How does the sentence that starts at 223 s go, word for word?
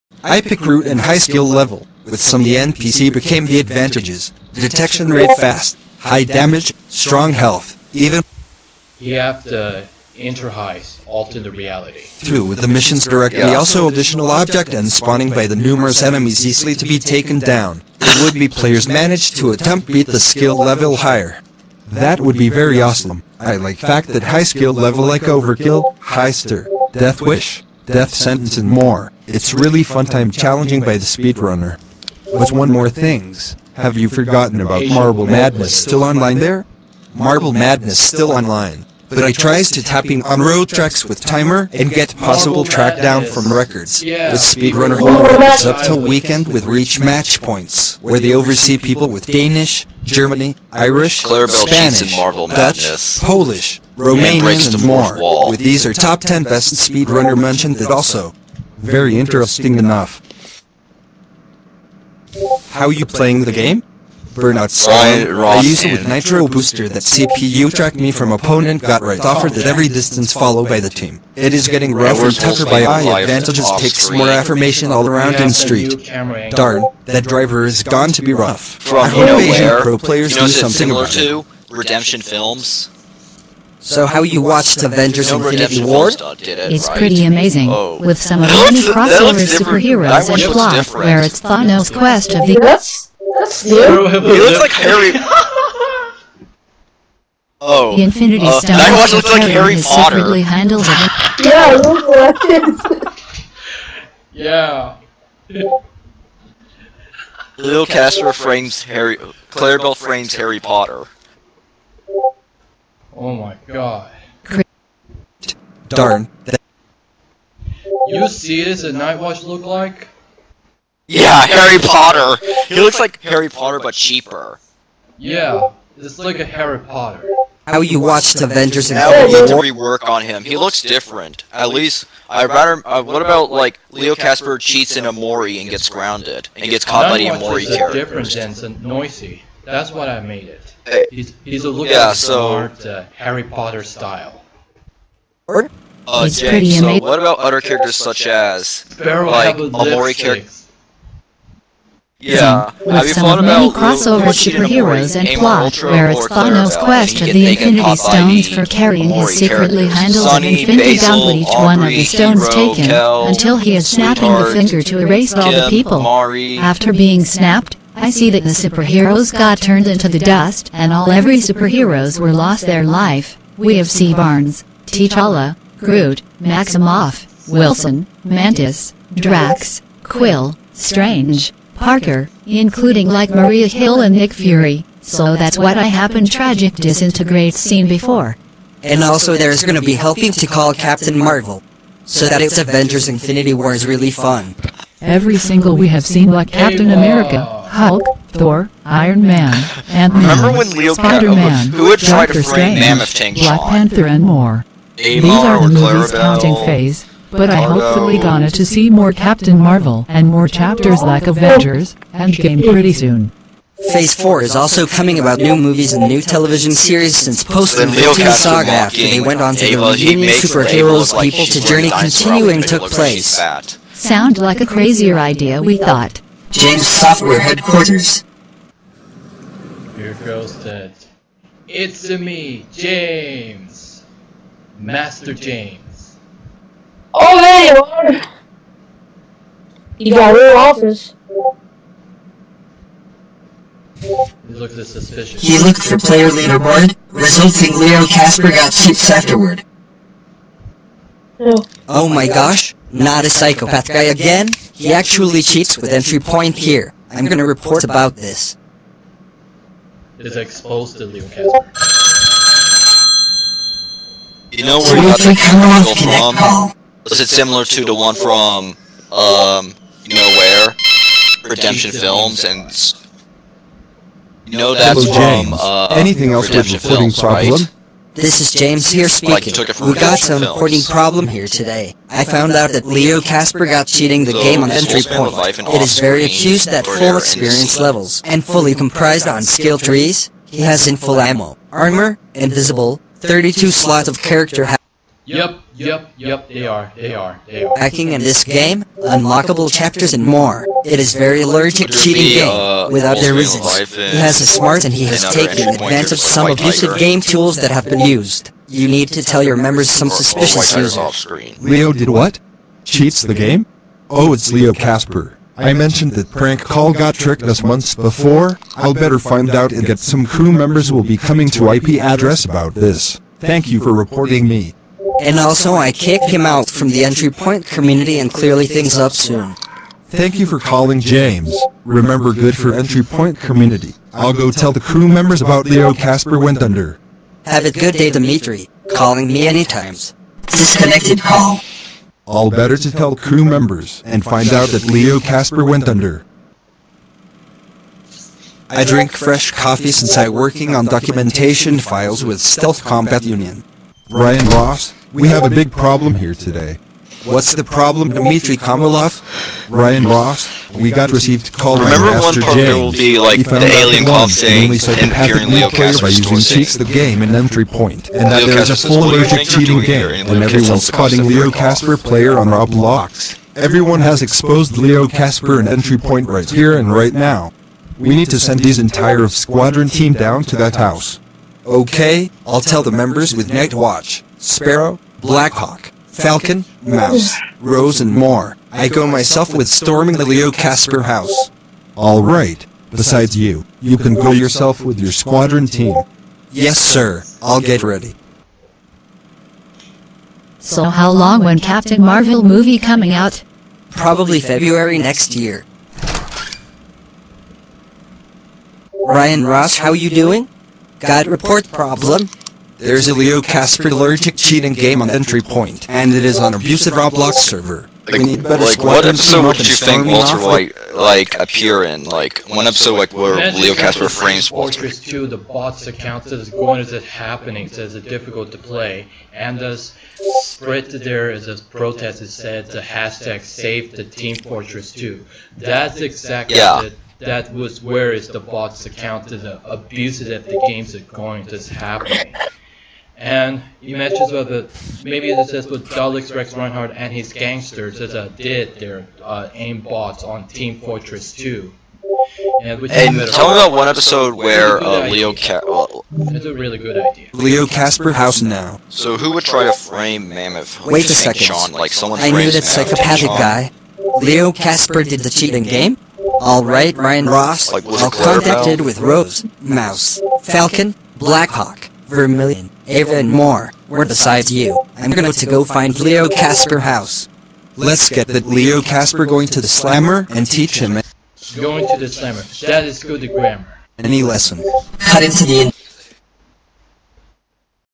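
Sound like a crazier idea we thought.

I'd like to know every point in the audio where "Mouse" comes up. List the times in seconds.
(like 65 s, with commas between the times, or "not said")
386 s, 469 s.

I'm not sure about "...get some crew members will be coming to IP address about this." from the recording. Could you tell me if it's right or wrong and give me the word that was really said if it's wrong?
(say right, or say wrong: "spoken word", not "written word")
right.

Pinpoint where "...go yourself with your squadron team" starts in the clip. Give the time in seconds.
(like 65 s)
394 s.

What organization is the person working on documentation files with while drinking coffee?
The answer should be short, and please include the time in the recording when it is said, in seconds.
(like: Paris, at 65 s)
Stealth Combat Union, at 352 s.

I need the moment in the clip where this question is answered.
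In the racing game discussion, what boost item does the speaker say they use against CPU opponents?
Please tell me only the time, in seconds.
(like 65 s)
66 s.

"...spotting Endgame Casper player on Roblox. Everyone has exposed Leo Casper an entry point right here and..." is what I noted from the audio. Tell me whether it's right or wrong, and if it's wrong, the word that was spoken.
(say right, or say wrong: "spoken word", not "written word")
wrong: "Leo", not "Endgame".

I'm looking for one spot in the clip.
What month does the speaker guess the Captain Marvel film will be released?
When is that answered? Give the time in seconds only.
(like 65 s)
404 s.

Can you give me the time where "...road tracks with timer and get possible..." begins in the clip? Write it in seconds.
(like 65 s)
40 s.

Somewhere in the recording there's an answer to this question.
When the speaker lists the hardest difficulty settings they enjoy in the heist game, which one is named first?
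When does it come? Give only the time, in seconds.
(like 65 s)
25 s.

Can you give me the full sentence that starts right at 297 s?
Hacking in this game, unlockable chapters and more.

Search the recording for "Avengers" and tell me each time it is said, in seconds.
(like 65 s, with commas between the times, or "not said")
84 s, 128 s, 192 s, 211 s.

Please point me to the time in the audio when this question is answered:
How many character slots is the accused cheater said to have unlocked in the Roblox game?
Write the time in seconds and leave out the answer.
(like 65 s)
293 s.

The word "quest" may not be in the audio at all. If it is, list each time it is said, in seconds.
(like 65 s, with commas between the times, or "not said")
91 s, 156 s.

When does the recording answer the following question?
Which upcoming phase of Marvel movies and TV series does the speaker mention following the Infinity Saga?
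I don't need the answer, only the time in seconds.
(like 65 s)
214 s.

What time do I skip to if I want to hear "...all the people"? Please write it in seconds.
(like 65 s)
165 s.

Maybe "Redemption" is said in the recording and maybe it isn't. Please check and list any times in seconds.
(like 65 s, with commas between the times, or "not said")
81 s, 271 s, 276 s.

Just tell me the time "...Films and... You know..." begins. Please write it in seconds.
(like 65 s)
271 s.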